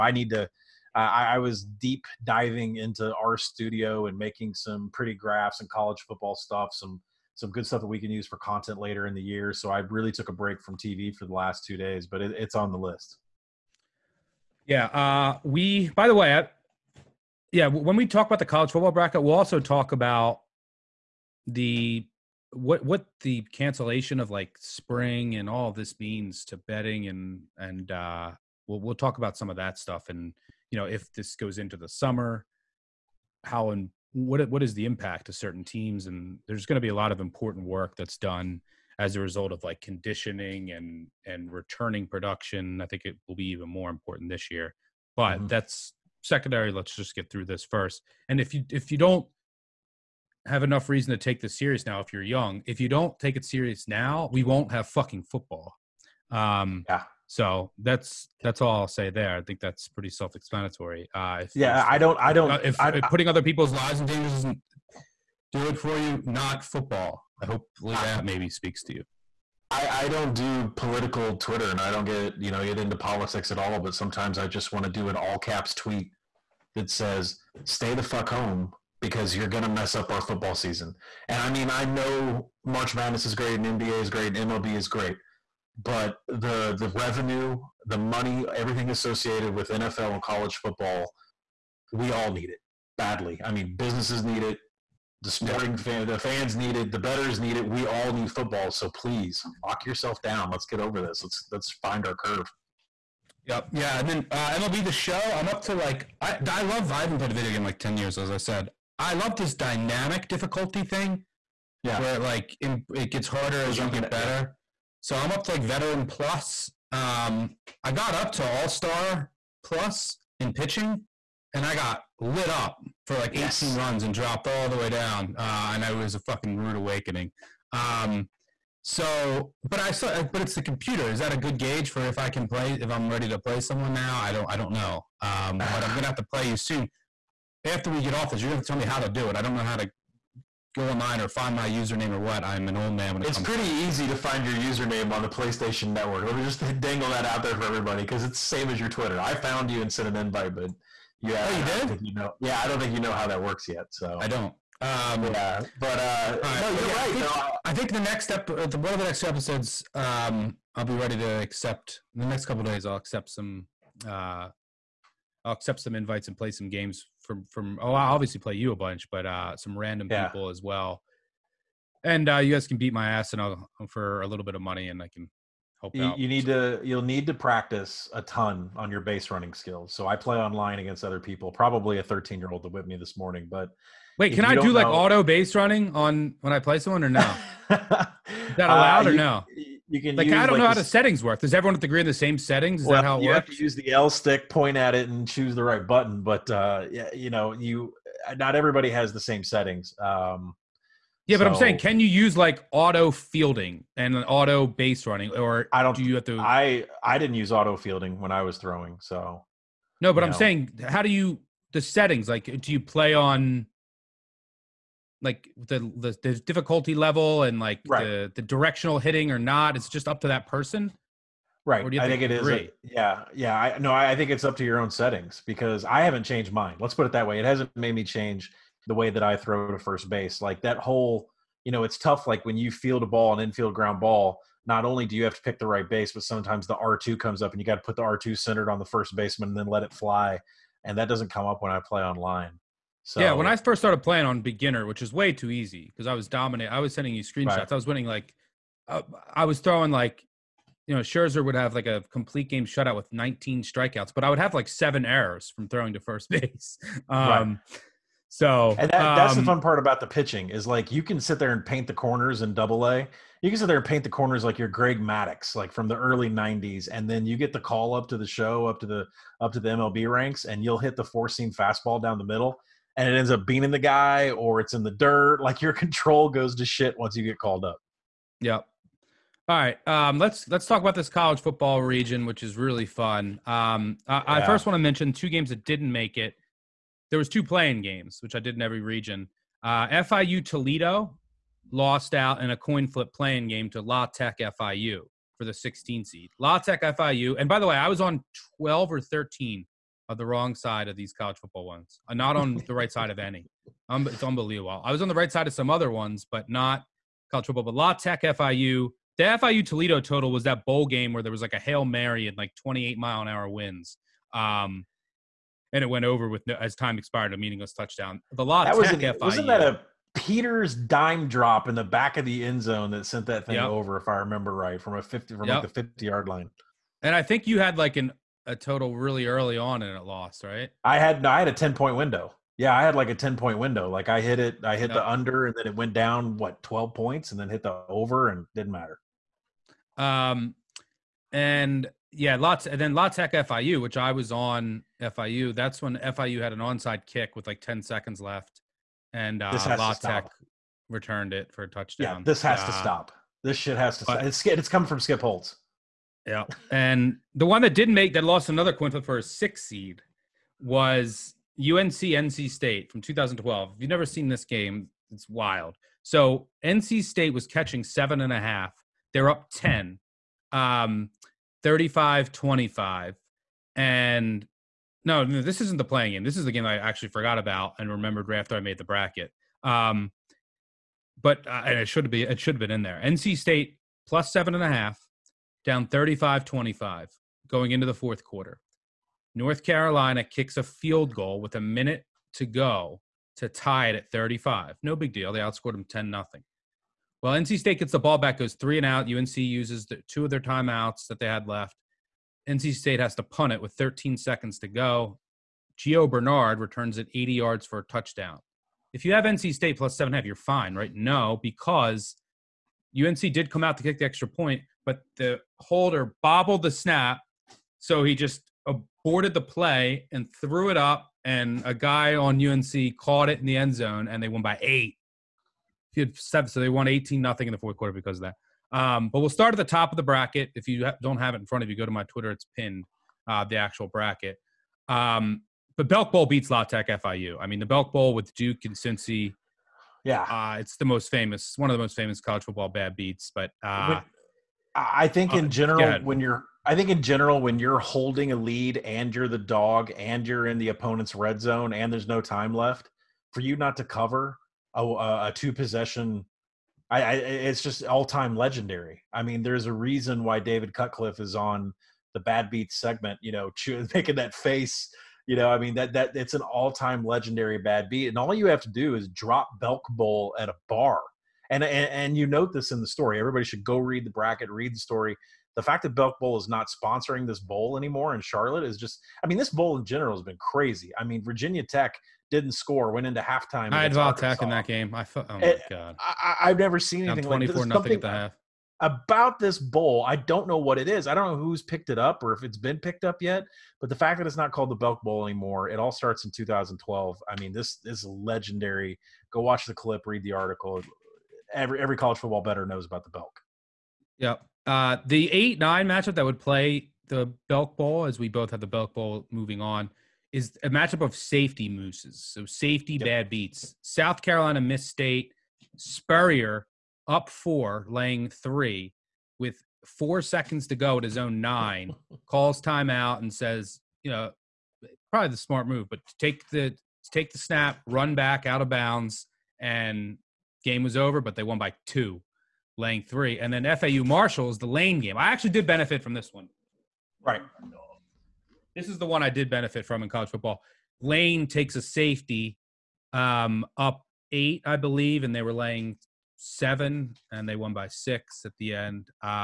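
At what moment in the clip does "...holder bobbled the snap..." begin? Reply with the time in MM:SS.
06:55.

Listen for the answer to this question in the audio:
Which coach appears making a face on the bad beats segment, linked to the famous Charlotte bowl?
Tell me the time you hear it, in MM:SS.
07:40.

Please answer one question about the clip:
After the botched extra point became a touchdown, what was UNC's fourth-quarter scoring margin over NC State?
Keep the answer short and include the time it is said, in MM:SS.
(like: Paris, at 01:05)
18-0, at 07:06.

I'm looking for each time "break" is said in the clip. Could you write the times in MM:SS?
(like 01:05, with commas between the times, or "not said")
00:10.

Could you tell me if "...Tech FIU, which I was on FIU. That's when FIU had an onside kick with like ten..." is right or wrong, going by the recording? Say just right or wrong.
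right.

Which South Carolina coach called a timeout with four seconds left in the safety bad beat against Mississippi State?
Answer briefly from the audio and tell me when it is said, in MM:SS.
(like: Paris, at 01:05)
Spurrier, at 08:35.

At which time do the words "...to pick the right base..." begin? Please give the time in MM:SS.
03:55.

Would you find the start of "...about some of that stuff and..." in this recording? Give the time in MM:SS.
00:29.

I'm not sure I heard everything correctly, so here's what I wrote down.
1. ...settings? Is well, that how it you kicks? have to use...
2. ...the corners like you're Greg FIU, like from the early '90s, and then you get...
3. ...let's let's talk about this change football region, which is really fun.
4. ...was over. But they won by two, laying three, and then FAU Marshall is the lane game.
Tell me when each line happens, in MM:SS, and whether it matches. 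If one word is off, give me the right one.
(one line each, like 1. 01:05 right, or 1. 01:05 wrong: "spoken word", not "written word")
1. 03:12 wrong: "works", not "kicks"
2. 04:24 wrong: "Maddux", not "FIU"
3. 04:40 wrong: "college", not "change"
4. 08:50 right.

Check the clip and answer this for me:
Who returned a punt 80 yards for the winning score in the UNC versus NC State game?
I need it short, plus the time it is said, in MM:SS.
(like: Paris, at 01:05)
Gio Bernard, at 06:45.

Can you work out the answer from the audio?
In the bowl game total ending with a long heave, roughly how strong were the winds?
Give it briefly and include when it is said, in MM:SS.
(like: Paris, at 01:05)
28 mph, at 05:12.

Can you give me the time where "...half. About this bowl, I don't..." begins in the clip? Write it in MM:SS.
08:08.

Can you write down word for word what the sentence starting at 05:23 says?
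over, if I remember right, from a fifty from yep.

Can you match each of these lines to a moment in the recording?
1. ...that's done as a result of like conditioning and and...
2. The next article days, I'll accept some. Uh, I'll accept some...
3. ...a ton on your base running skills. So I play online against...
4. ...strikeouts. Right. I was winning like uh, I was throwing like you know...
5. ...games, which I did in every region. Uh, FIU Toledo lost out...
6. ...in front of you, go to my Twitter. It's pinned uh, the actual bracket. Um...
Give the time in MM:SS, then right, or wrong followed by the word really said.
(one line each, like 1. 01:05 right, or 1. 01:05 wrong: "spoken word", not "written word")
1. 00:37 right
2. 02:42 wrong: "couple", not "article"
3. 02:58 right
4. 04:07 wrong: "screenshots", not "strikeouts"
5. 04:47 right
6. 07:11 right.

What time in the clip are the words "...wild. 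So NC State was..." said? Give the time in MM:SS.
06:05.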